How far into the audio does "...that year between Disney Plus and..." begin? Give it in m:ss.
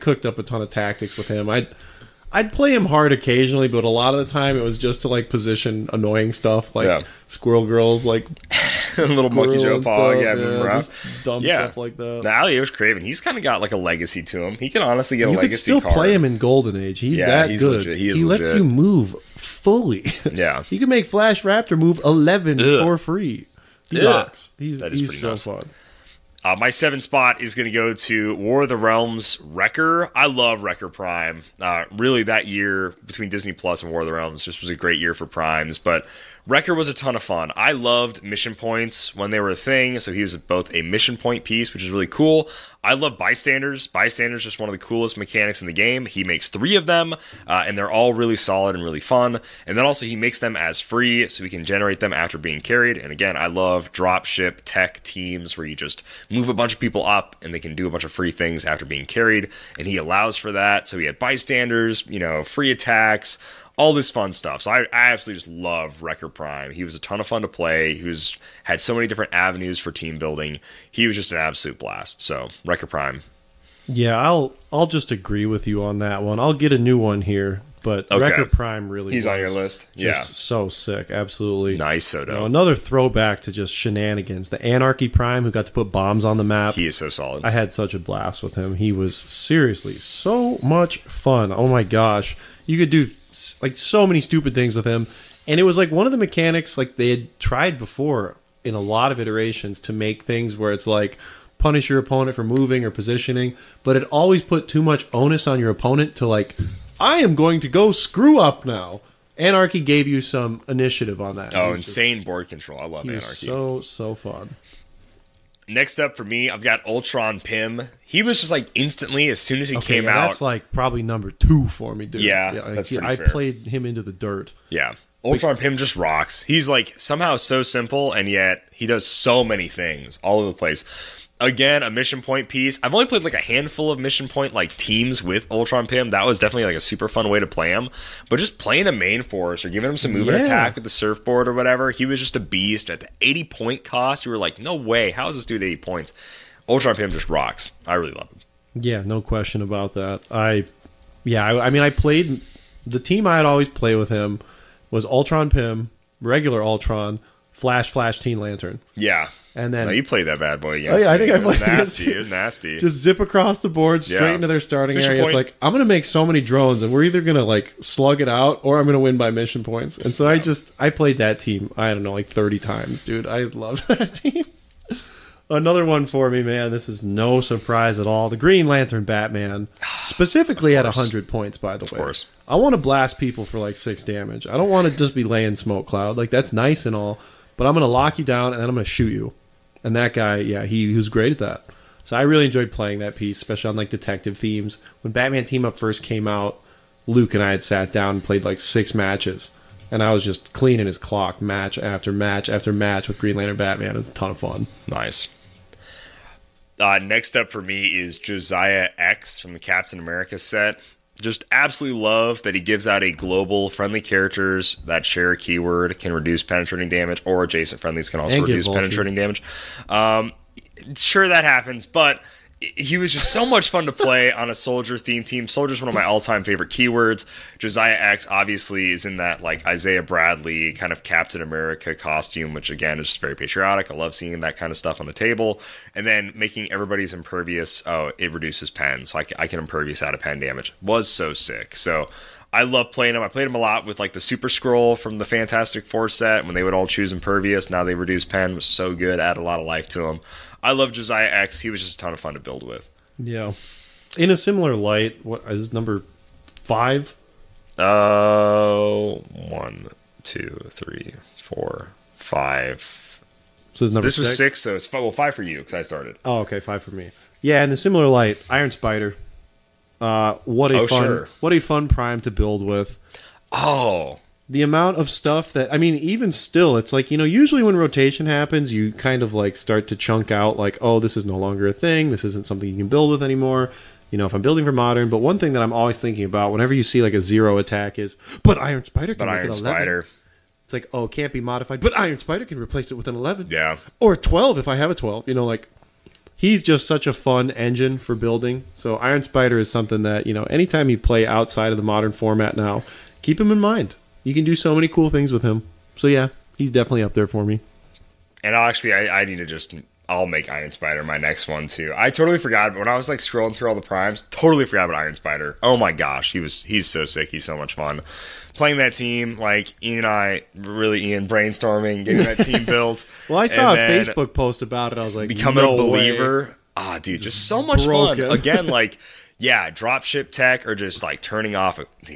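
0:32.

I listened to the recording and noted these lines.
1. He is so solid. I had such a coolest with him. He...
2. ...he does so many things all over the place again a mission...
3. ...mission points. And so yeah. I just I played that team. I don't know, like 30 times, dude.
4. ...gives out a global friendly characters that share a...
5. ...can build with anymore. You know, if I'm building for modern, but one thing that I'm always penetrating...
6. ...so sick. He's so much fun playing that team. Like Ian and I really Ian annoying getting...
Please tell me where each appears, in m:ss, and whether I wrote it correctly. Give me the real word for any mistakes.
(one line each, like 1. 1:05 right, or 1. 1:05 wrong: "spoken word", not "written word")
1. 1:26 wrong: "blast", not "coolest"
2. 2:08 right
3. 2:49 right
4. 3:32 right
5. 4:42 wrong: "thinking", not "penetrating"
6. 5:16 wrong: "brainstorming", not "annoying".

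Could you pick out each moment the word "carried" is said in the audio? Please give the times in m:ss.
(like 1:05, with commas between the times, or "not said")
0:52, 0:59.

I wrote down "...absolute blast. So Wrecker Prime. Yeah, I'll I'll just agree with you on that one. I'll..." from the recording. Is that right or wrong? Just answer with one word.
right.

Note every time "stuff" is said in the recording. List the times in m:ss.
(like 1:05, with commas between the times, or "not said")
0:06, 0:11, 1:04, 3:54, 4:35.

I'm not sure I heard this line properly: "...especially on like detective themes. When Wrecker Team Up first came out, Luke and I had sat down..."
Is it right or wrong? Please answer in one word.
wrong.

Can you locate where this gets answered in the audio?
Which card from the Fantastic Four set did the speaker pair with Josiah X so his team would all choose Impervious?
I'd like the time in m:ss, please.
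4:04.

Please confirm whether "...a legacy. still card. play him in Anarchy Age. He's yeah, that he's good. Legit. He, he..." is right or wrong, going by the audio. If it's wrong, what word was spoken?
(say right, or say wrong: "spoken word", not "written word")
wrong: "Golden", not "Anarchy".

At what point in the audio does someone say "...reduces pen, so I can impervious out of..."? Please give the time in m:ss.
3:58.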